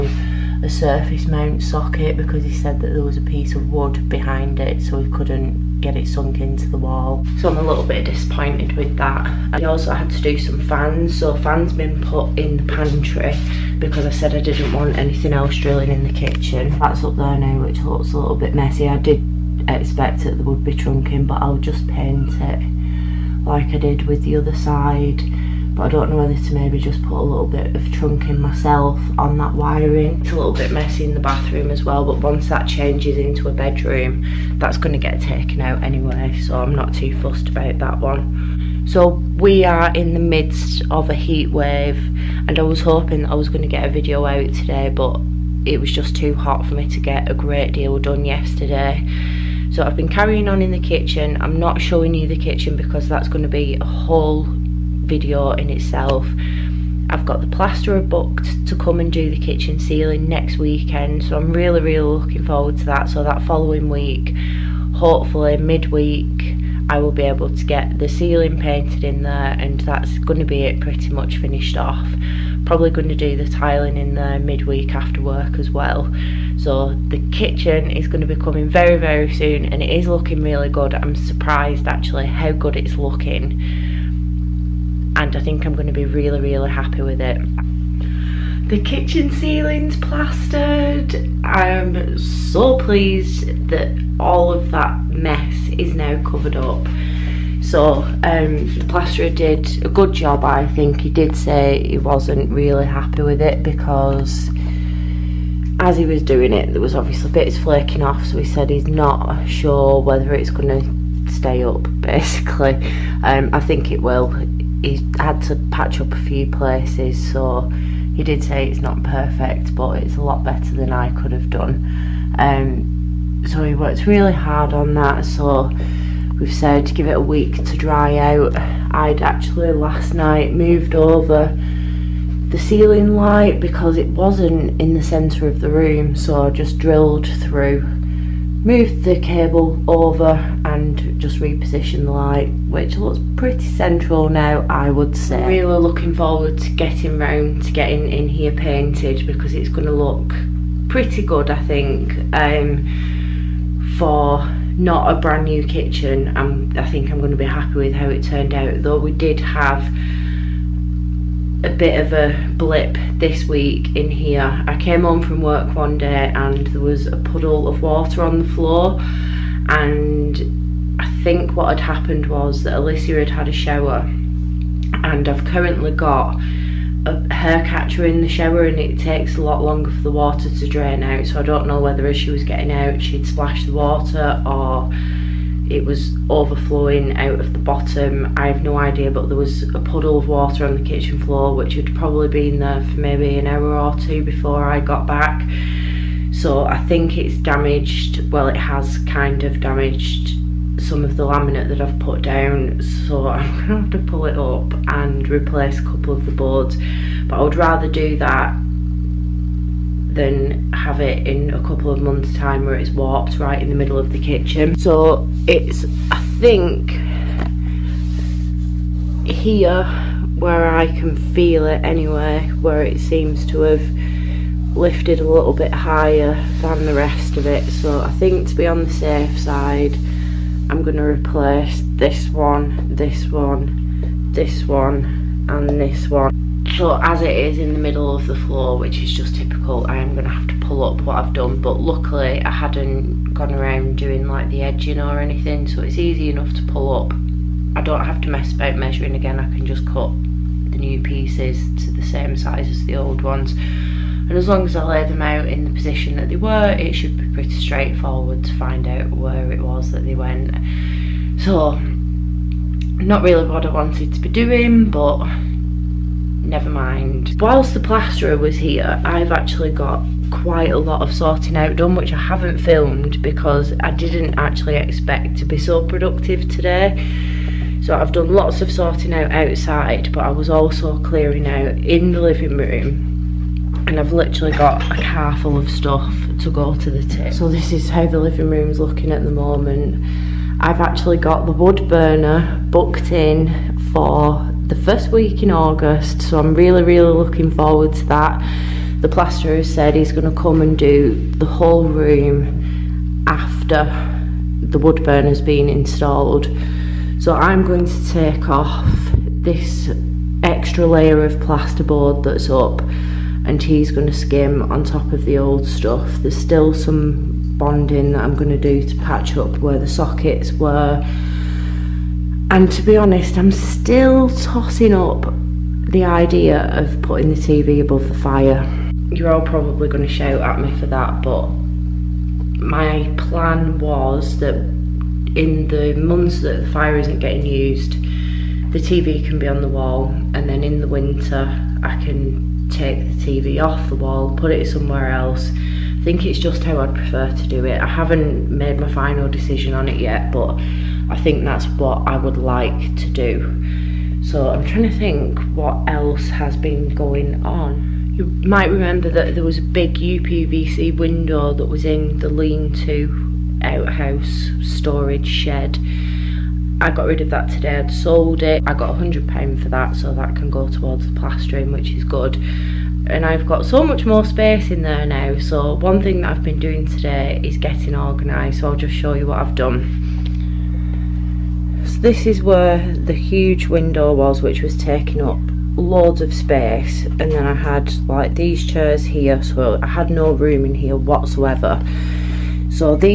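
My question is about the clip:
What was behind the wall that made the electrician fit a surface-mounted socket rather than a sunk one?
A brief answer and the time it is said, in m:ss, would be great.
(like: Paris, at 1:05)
A piece of wood, at 0:03.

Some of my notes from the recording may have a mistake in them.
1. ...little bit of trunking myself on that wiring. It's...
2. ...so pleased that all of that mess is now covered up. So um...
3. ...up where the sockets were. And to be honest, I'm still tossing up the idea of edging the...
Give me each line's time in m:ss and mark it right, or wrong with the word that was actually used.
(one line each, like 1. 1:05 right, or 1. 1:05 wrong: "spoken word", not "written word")
1. 0:27 right
2. 1:32 right
3. 5:19 wrong: "putting", not "edging".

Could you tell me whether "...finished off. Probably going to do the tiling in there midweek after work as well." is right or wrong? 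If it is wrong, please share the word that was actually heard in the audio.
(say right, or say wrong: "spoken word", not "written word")
right.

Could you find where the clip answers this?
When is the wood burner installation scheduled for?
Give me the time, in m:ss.
4:54.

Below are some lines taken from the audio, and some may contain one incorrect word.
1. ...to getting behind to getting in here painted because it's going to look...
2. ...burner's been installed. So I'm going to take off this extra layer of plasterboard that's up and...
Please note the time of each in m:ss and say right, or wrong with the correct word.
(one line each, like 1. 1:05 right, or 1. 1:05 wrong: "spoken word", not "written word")
1. 2:26 wrong: "round", not "behind"
2. 5:05 right.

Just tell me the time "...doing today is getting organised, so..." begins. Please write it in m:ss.
6:16.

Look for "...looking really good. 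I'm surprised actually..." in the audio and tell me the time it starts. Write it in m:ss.
1:20.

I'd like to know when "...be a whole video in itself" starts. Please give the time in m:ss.
0:53.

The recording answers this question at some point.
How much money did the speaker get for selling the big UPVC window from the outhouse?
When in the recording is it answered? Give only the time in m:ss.
6:09.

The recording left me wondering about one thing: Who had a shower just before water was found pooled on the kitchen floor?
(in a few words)
Alicia.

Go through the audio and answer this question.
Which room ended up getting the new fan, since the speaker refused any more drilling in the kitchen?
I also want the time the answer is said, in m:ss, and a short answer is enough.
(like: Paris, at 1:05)
The pantry, at 0:12.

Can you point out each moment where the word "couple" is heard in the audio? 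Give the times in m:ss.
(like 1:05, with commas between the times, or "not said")
3:25, 3:31.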